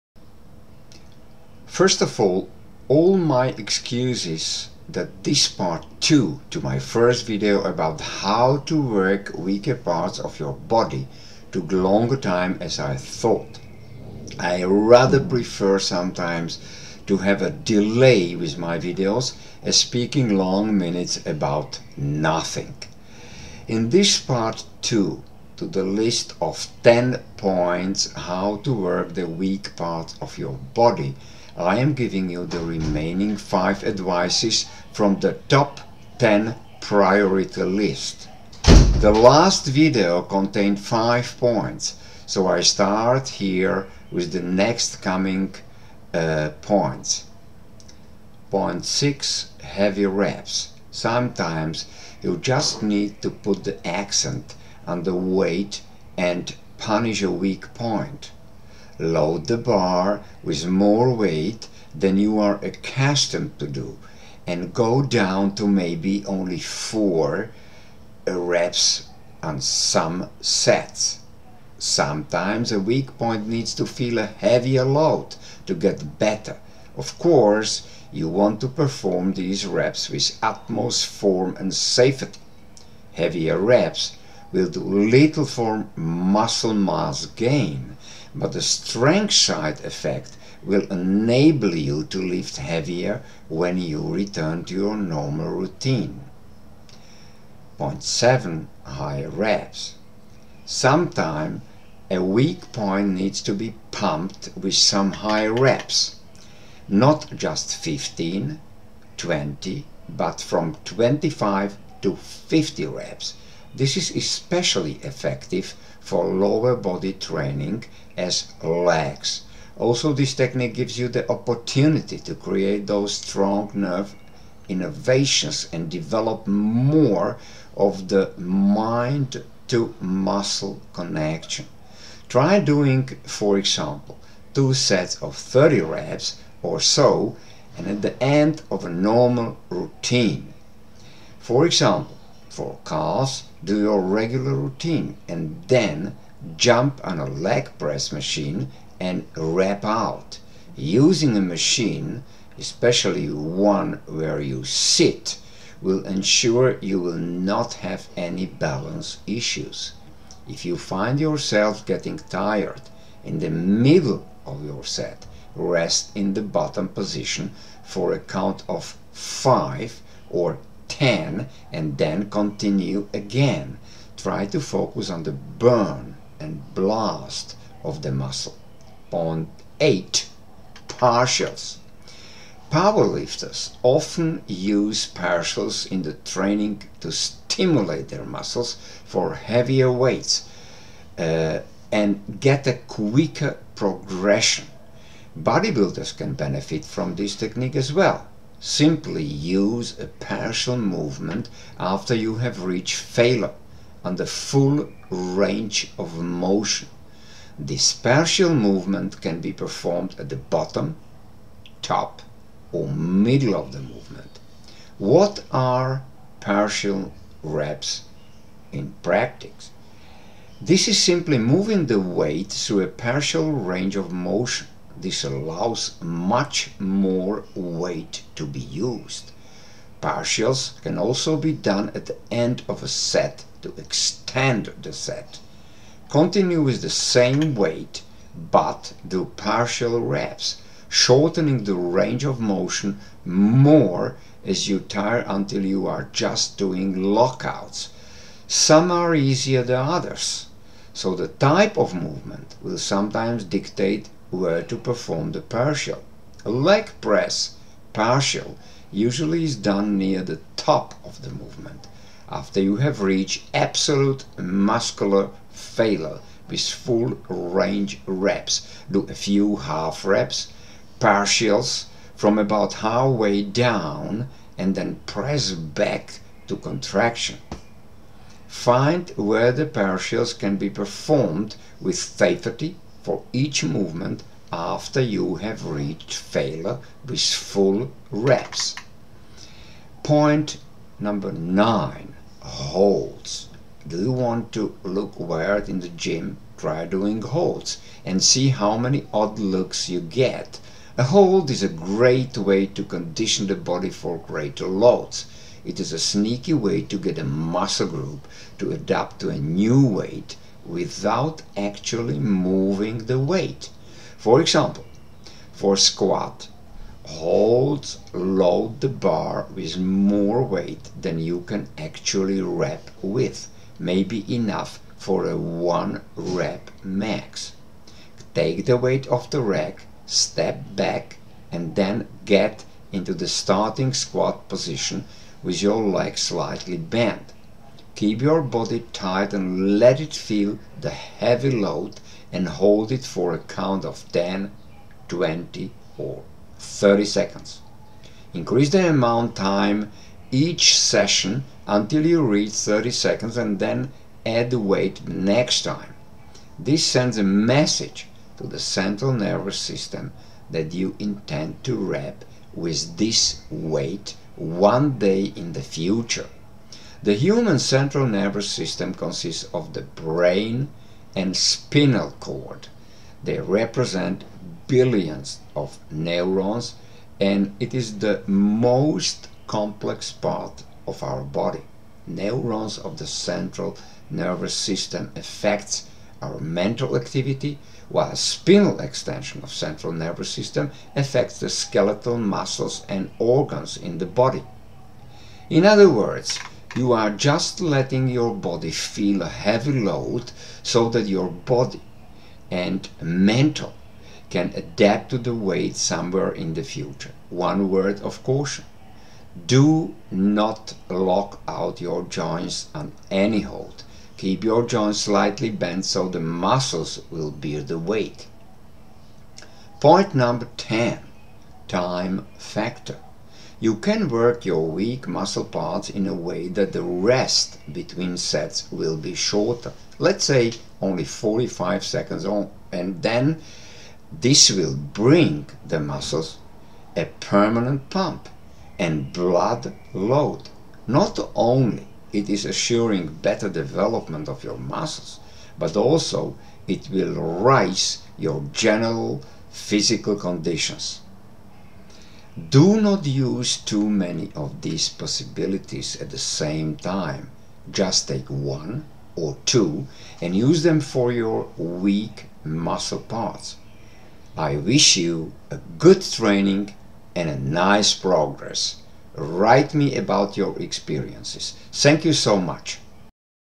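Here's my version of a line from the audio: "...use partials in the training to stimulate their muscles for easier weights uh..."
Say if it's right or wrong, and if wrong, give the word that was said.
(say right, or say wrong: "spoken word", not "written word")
wrong: "heavier", not "easier".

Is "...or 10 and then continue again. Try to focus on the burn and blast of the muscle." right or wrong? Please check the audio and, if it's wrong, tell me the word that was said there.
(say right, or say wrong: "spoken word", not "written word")
right.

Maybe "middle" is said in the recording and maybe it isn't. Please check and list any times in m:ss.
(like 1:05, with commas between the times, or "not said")
2:43, 3:32.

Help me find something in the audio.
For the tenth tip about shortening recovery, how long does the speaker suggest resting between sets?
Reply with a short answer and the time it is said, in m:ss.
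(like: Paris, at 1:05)
45 seconds, at 7:11.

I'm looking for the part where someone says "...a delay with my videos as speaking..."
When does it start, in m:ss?
0:17.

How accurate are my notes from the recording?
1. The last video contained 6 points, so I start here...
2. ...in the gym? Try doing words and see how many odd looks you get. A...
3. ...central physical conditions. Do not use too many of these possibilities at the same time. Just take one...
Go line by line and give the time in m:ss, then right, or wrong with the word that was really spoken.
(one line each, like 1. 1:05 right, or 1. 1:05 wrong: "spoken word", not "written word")
1. 0:39 wrong: "5", not "6"
2. 4:55 wrong: "holds", not "words"
3. 7:28 wrong: "general", not "central".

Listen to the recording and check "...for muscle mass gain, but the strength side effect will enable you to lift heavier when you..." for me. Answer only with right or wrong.
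right.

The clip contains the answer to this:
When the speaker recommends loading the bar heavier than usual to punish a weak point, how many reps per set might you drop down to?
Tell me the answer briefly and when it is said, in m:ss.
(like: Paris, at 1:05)
4, at 1:06.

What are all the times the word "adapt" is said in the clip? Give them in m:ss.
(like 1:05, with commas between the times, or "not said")
5:08, 6:44.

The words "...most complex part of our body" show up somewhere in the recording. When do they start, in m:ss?
6:18.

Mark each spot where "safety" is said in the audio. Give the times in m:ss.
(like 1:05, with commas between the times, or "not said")
1:21, 4:41.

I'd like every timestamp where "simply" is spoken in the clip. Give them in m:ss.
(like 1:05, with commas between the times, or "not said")
3:18, 3:41.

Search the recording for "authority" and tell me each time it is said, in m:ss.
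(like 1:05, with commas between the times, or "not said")
not said.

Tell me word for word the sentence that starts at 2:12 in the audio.
Try doing, for example, two sets of 30 reps or so and at the end of a normal routine.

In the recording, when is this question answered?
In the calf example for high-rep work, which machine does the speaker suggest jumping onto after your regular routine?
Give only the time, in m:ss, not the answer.
2:27.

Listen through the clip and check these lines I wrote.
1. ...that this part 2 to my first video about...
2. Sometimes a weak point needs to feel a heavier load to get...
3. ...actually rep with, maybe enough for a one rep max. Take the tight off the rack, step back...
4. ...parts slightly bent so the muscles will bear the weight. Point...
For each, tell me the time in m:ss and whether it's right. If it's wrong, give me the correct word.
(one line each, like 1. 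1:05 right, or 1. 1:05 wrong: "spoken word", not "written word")
1. 0:04 right
2. 1:11 right
3. 5:21 wrong: "weight", not "tight"
4. 6:54 wrong: "joints", not "parts".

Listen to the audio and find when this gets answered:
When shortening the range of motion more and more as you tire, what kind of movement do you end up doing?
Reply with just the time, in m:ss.
4:07.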